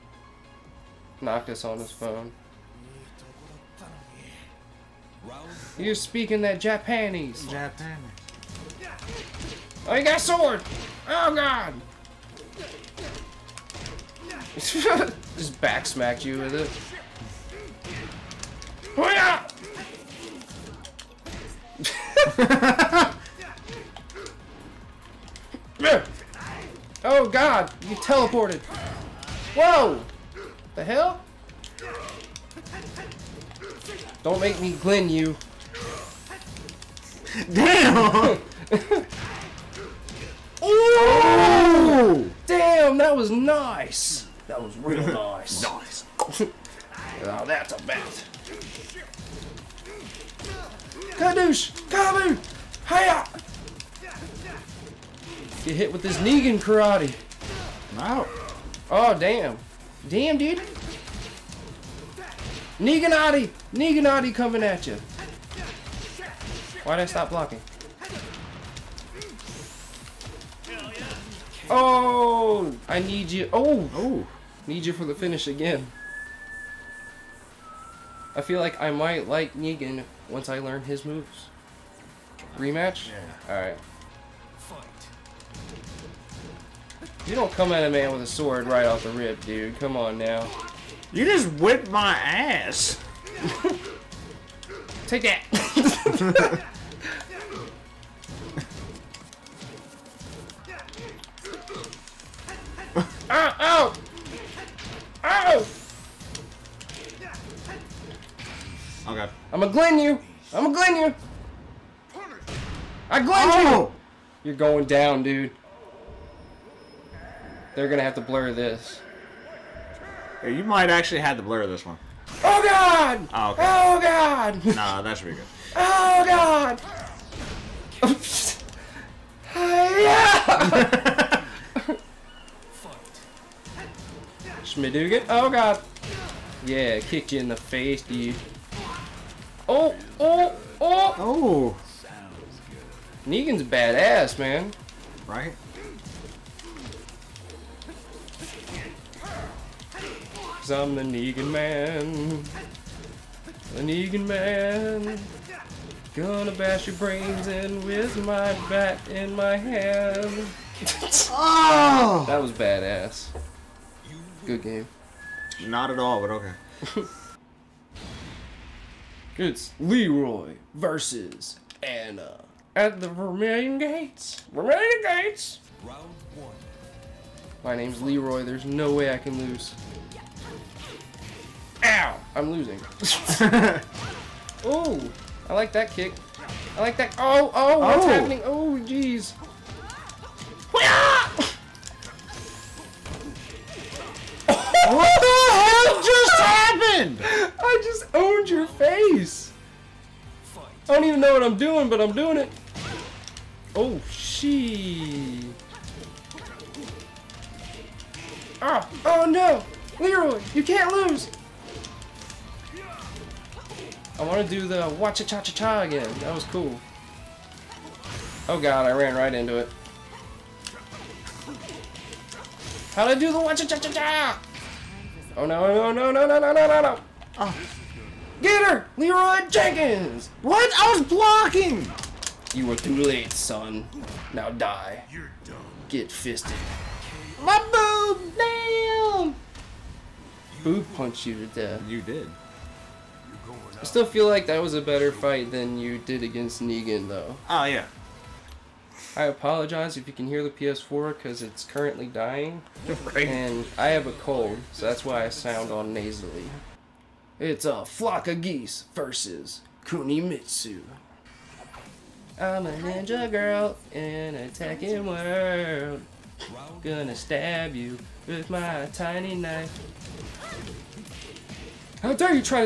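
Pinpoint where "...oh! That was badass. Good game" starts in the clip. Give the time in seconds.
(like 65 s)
161 s.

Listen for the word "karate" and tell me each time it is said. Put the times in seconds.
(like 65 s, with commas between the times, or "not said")
56 s.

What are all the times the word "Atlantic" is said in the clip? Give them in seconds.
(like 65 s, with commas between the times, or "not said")
not said.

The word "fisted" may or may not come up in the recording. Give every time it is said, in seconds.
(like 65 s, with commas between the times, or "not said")
236 s.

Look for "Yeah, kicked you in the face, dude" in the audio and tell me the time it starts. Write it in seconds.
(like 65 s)
136 s.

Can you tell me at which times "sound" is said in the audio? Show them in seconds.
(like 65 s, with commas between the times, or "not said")
255 s.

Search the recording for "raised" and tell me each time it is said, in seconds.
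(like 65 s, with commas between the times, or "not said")
not said.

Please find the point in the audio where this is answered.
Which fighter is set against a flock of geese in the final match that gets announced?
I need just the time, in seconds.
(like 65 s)
259 s.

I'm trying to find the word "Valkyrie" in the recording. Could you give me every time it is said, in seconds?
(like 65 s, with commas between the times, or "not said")
not said.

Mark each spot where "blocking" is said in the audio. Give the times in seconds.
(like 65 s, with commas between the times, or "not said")
67 s, 231 s.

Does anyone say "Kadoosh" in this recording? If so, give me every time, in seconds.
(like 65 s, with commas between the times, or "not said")
51 s.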